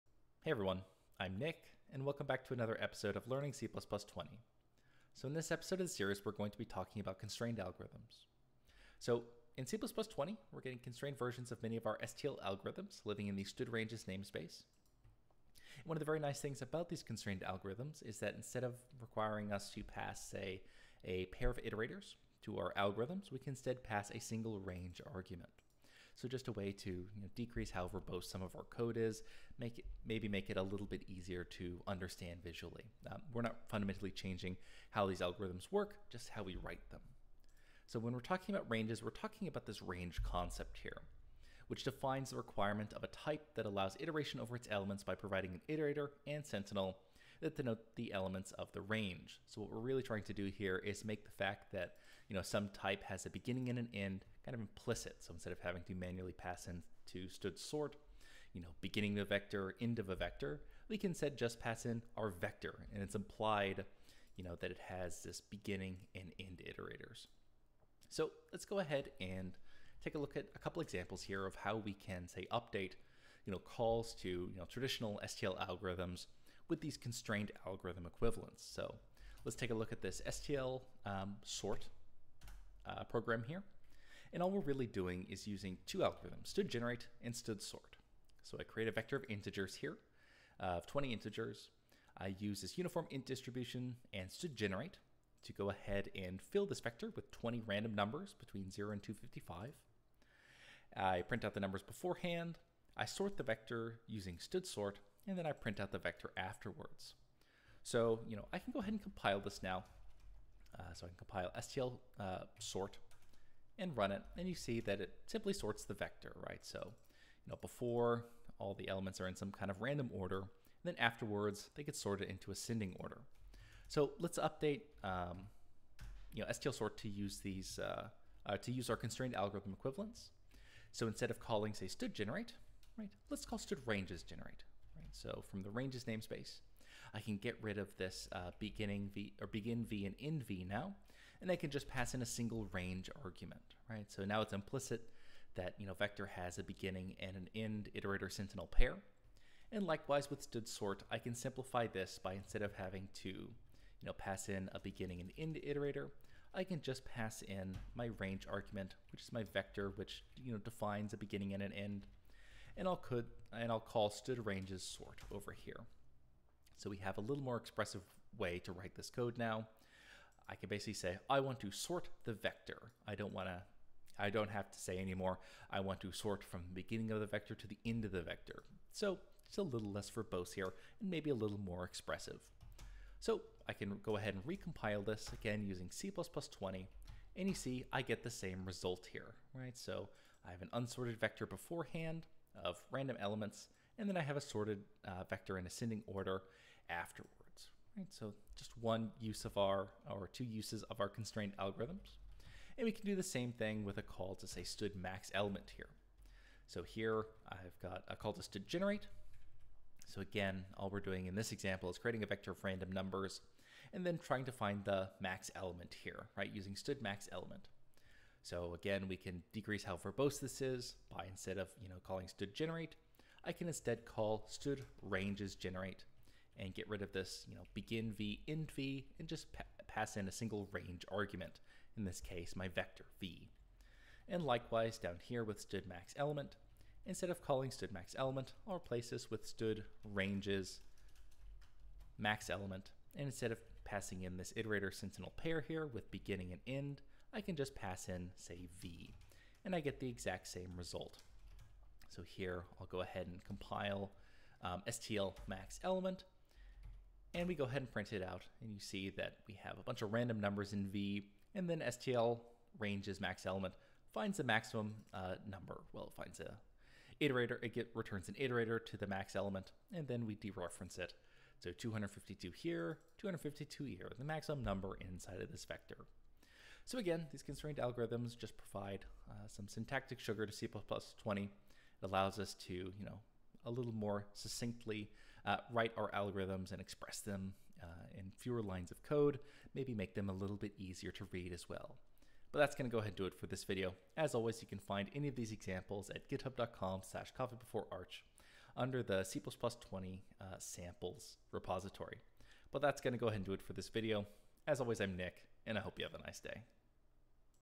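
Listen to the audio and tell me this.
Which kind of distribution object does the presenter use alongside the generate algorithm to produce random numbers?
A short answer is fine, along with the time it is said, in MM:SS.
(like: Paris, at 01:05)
uniform int distribution, at 01:32.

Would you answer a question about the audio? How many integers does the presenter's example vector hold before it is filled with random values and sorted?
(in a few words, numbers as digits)
20.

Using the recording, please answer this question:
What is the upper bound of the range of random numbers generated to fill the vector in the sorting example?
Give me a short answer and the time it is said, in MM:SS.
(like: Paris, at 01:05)
255, at 01:39.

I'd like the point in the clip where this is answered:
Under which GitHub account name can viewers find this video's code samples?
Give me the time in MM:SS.
04:57.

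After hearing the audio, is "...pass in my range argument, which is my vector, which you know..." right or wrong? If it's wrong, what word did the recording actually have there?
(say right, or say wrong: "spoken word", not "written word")
right.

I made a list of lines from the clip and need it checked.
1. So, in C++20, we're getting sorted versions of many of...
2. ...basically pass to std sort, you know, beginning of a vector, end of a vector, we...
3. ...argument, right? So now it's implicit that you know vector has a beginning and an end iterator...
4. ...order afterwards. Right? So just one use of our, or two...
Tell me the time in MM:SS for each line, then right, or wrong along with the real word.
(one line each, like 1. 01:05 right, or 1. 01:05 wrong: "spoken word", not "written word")
1. 00:08 wrong: "constrained", not "sorted"
2. 00:55 wrong: "manually", not "basically"
3. 02:23 right
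4. 03:16 right.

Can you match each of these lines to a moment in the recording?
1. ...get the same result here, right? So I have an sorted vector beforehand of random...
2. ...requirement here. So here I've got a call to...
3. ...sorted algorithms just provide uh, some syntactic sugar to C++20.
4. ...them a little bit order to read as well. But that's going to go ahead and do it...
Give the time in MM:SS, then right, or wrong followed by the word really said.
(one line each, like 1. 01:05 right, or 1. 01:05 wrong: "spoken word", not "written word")
1. 03:08 wrong: "unsorted", not "sorted"
2. 03:25 wrong: "element", not "requirement"
3. 04:37 wrong: "constrained", not "sorted"
4. 04:50 wrong: "easier", not "order".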